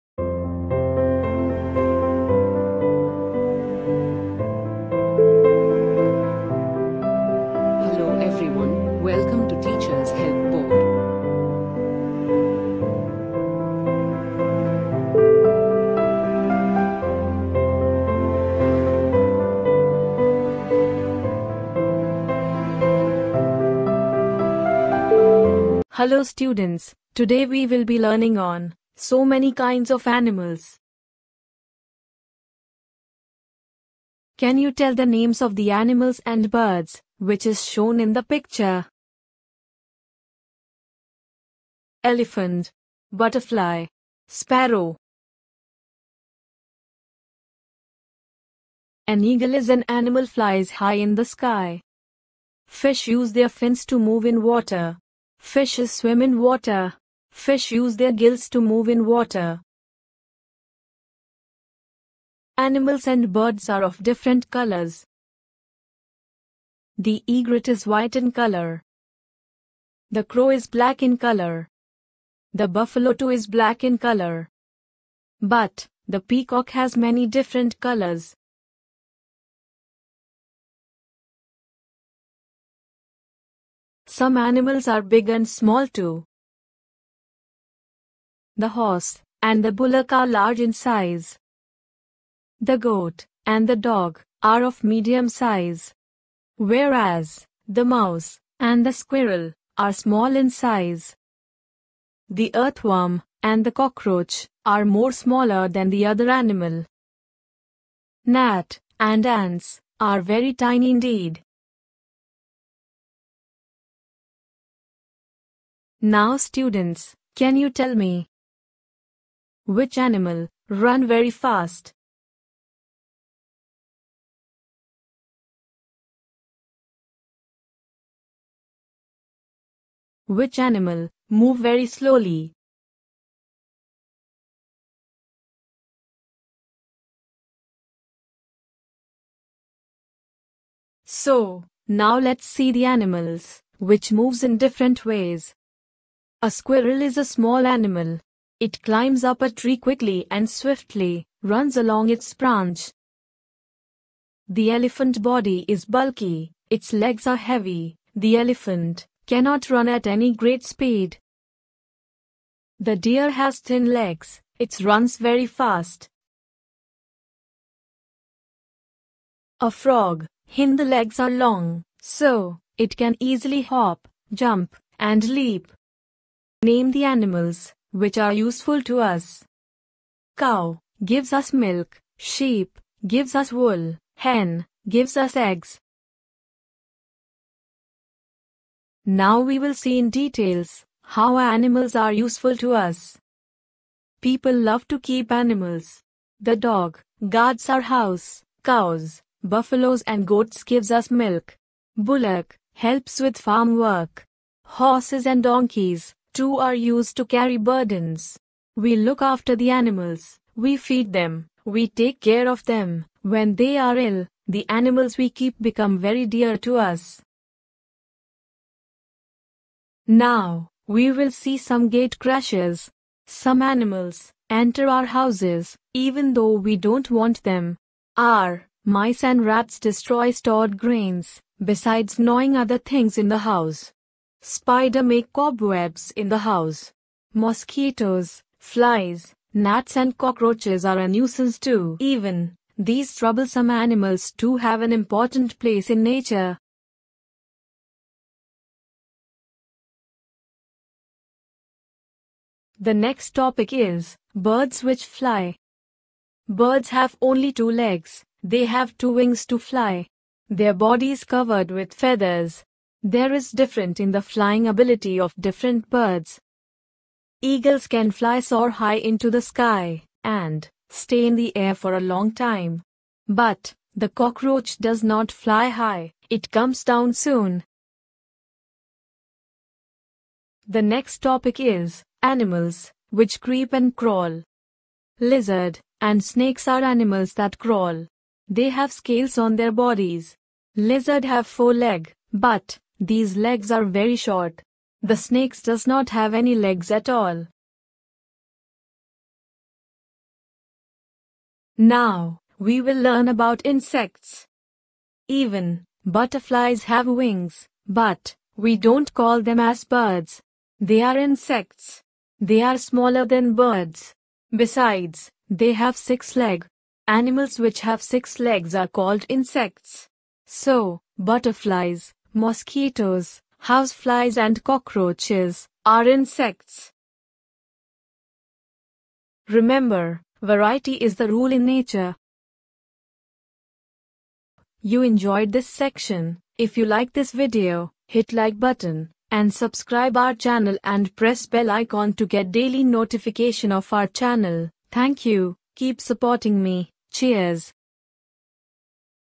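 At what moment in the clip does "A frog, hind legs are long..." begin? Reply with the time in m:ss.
2:49.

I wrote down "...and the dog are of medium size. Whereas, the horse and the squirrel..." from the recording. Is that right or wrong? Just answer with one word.
wrong.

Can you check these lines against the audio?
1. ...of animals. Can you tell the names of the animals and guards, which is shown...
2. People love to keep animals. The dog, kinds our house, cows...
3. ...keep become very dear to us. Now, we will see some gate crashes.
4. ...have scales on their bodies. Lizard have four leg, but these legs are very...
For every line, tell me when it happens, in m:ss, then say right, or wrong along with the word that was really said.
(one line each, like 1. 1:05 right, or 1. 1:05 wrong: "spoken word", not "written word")
1. 0:29 wrong: "birds", not "guards"
2. 3:14 wrong: "guards", not "kinds"
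3. 3:35 right
4. 4:48 right.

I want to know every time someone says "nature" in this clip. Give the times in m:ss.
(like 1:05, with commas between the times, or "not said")
4:06, 5:31.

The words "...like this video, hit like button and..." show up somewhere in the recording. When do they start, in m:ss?
5:36.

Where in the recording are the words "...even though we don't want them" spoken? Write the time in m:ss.
3:45.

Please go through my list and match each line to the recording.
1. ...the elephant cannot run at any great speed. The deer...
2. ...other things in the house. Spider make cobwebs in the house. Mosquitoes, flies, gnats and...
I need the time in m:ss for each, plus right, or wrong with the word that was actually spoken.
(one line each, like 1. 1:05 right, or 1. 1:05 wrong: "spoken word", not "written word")
1. 2:38 right
2. 3:52 right.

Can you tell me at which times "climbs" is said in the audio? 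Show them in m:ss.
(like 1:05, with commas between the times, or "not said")
2:28.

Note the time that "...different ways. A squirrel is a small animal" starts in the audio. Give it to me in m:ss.
2:24.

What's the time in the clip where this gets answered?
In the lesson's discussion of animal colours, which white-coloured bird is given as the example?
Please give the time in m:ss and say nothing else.
1:07.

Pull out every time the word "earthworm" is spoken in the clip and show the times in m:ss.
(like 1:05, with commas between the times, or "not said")
1:42.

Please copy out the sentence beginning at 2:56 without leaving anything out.
Name the animals, which are useful to us.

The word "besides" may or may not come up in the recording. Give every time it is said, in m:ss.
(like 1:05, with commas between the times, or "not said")
3:51, 5:14.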